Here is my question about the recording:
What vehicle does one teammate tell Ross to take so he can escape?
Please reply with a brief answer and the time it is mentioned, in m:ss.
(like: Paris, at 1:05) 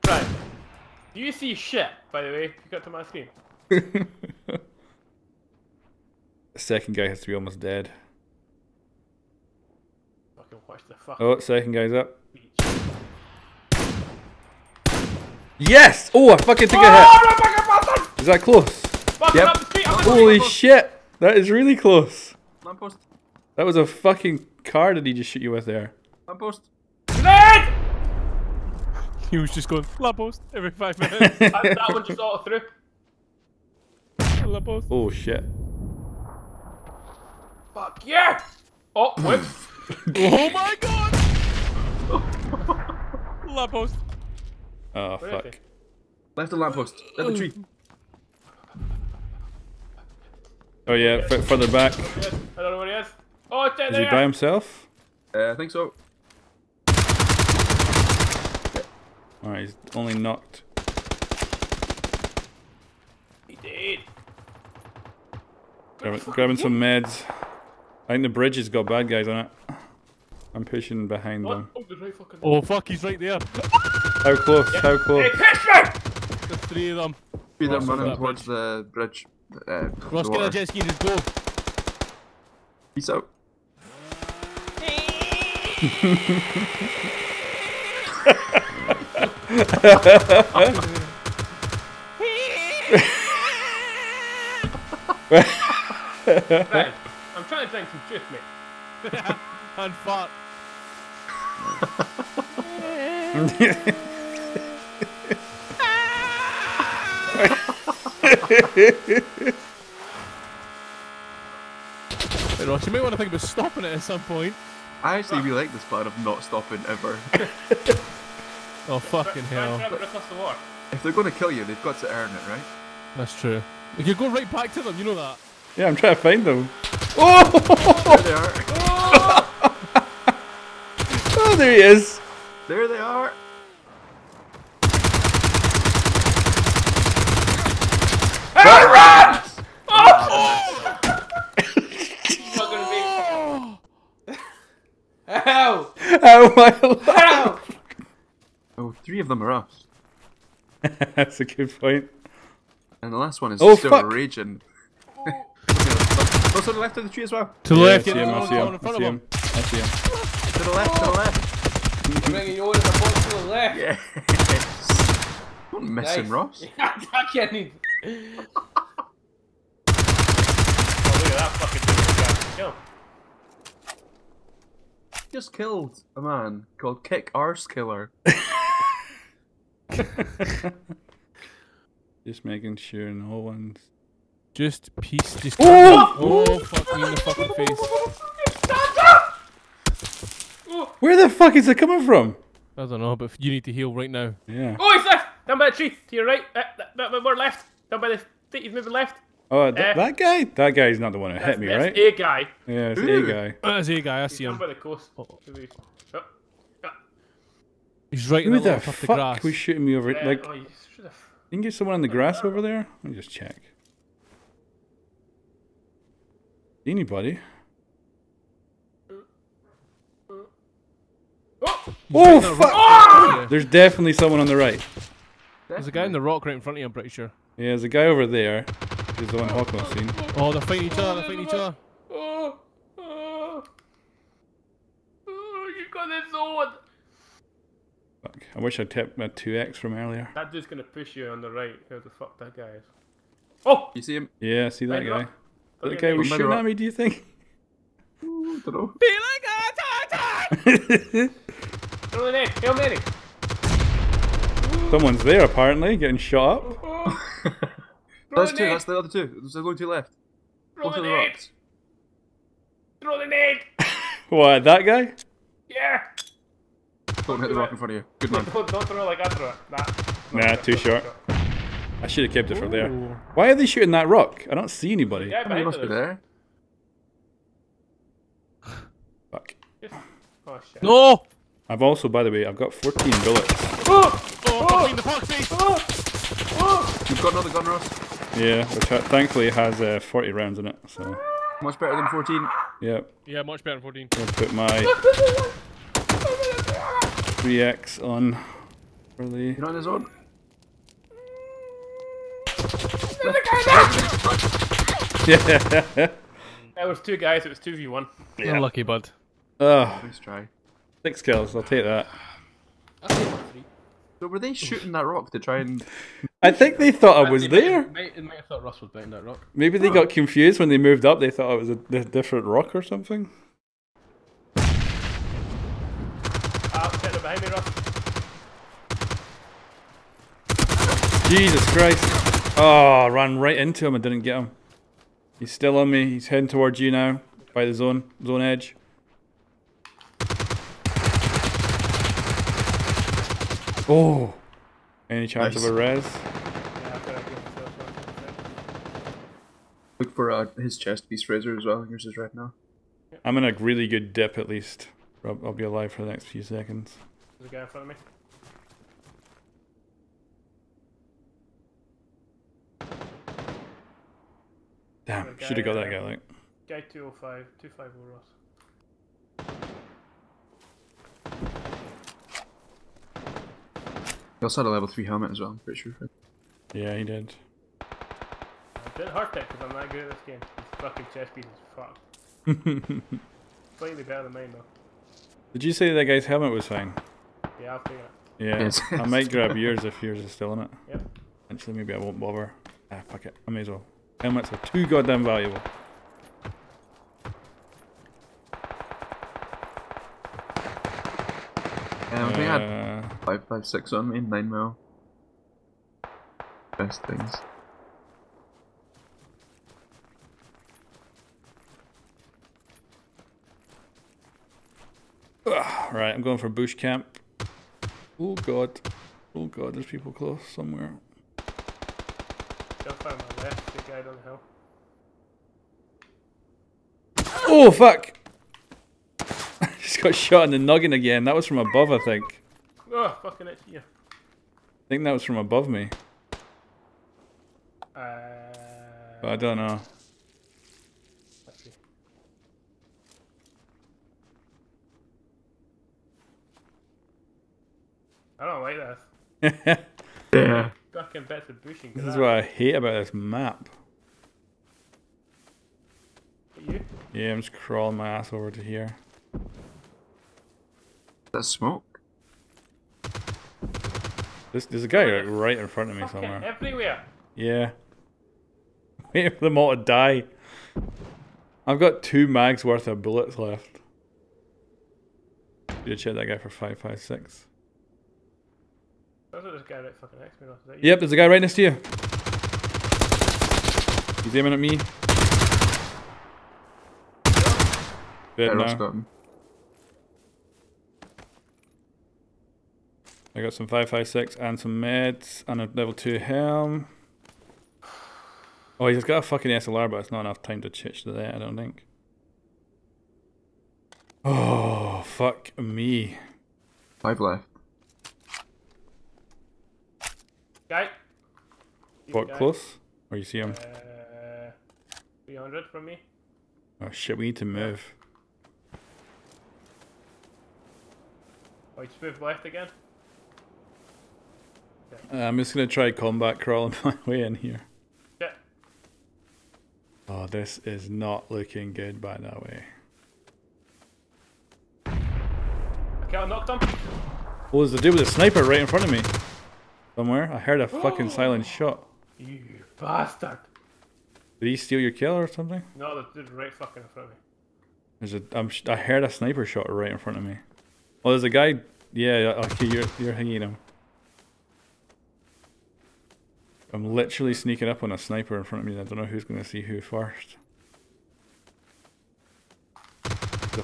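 Jet ski, at 1:20.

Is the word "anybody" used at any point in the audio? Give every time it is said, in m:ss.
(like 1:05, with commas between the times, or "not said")
3:36, 4:34.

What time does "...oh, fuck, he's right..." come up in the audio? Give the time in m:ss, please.
1:12.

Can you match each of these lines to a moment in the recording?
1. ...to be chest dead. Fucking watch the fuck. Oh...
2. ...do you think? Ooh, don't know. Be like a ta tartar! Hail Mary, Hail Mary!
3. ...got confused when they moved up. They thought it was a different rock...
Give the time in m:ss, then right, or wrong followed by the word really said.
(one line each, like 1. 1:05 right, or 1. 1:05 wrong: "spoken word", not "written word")
1. 0:07 wrong: "almost", not "chest"
2. 4:06 right
3. 5:19 right.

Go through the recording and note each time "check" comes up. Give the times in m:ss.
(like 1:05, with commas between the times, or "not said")
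3:33, 7:55.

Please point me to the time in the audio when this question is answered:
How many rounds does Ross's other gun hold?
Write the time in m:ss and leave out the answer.
4:49.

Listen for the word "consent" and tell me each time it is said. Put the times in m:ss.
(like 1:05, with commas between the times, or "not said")
not said.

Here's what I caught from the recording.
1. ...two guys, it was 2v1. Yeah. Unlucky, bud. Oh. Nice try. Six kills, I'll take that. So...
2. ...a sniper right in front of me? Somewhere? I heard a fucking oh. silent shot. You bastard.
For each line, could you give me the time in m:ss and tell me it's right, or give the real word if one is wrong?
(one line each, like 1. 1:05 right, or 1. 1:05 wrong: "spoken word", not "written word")
1. 5:07 right
2. 8:58 right.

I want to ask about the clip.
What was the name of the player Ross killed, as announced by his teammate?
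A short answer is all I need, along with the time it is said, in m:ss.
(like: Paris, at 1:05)
Kick Arse Killer, at 2:57.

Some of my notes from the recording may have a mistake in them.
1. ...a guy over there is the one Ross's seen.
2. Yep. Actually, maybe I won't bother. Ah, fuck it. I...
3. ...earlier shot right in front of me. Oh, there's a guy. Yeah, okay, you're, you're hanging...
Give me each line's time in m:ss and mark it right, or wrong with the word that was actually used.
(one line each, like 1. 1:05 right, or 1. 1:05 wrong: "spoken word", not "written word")
1. 3:47 wrong: "Hawker", not "Ross"
2. 6:30 right
3. 9:09 wrong: "sniper", not "earlier".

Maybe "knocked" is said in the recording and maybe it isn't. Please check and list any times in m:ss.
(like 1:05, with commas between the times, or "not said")
1:00, 8:56.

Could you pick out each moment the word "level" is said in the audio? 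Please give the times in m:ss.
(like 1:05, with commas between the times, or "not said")
6:14, 8:15.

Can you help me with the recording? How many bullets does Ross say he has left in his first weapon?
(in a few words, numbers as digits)
14.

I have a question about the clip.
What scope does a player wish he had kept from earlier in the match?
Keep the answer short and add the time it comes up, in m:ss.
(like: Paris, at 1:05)
2x, at 3:59.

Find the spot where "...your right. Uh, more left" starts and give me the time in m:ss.
3:16.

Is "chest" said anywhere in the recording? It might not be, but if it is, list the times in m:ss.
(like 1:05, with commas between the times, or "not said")
5:50, 6:21.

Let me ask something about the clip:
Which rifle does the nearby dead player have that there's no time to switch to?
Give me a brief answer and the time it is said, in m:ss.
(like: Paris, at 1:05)
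SLR, at 8:19.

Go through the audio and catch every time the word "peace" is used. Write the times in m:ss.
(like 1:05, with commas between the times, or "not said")
1:22, 3:04.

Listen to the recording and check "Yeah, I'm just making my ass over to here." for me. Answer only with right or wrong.
wrong.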